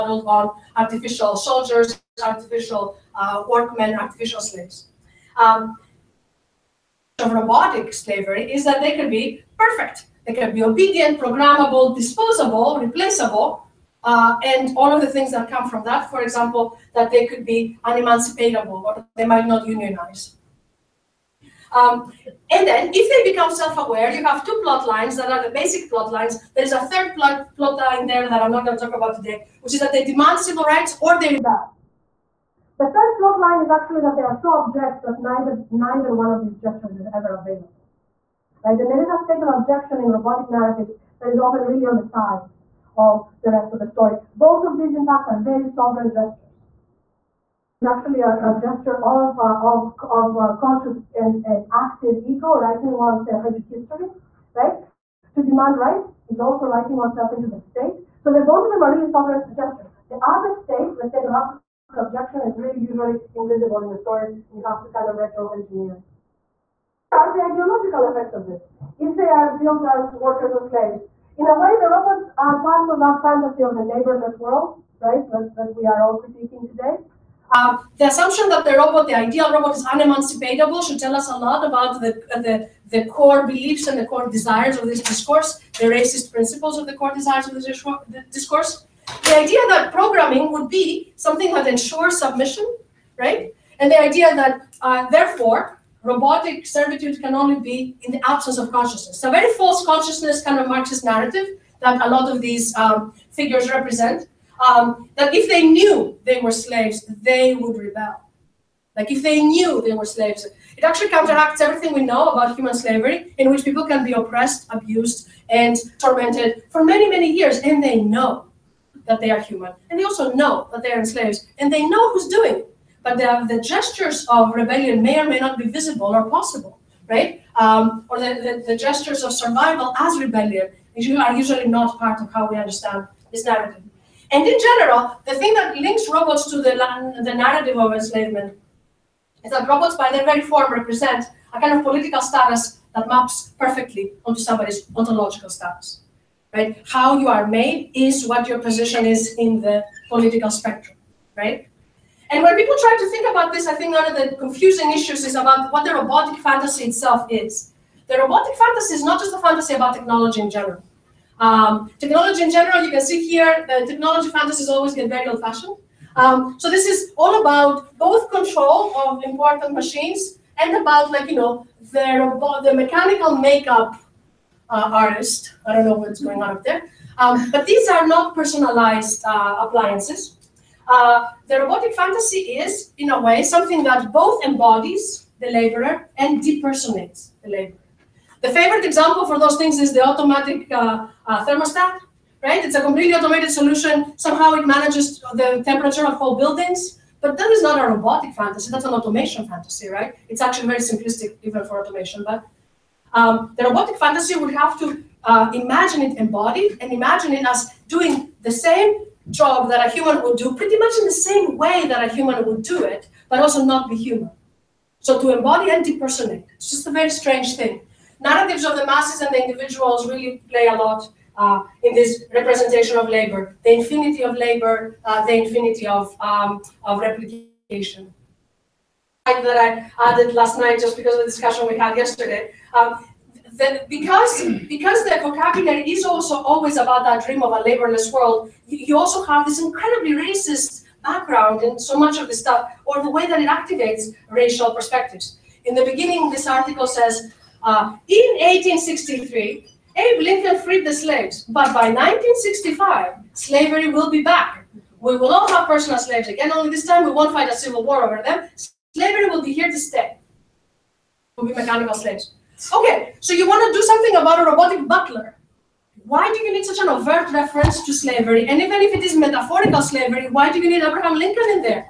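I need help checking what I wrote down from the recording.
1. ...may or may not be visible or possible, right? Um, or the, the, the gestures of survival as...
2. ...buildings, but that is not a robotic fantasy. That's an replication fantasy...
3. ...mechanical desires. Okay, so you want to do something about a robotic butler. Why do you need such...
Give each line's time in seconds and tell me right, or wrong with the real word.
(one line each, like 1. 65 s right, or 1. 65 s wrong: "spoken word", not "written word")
1. 125 s right
2. 196 s wrong: "automation", not "replication"
3. 261 s wrong: "slaves", not "desires".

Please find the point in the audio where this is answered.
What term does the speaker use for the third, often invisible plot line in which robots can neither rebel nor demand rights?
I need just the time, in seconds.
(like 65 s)
61 s.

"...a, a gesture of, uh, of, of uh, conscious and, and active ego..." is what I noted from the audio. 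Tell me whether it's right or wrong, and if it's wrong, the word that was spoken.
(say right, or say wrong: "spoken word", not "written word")
right.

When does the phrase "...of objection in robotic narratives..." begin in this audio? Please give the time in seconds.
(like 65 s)
39 s.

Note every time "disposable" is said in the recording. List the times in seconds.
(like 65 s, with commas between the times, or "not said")
11 s.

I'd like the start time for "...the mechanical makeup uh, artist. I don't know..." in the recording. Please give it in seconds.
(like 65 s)
172 s.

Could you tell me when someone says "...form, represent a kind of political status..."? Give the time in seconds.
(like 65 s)
140 s.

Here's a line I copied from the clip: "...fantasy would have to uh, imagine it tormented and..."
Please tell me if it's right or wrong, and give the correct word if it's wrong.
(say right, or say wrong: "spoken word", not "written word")
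wrong: "embodied", not "tormented".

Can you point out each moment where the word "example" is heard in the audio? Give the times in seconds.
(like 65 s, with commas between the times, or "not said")
16 s, 188 s.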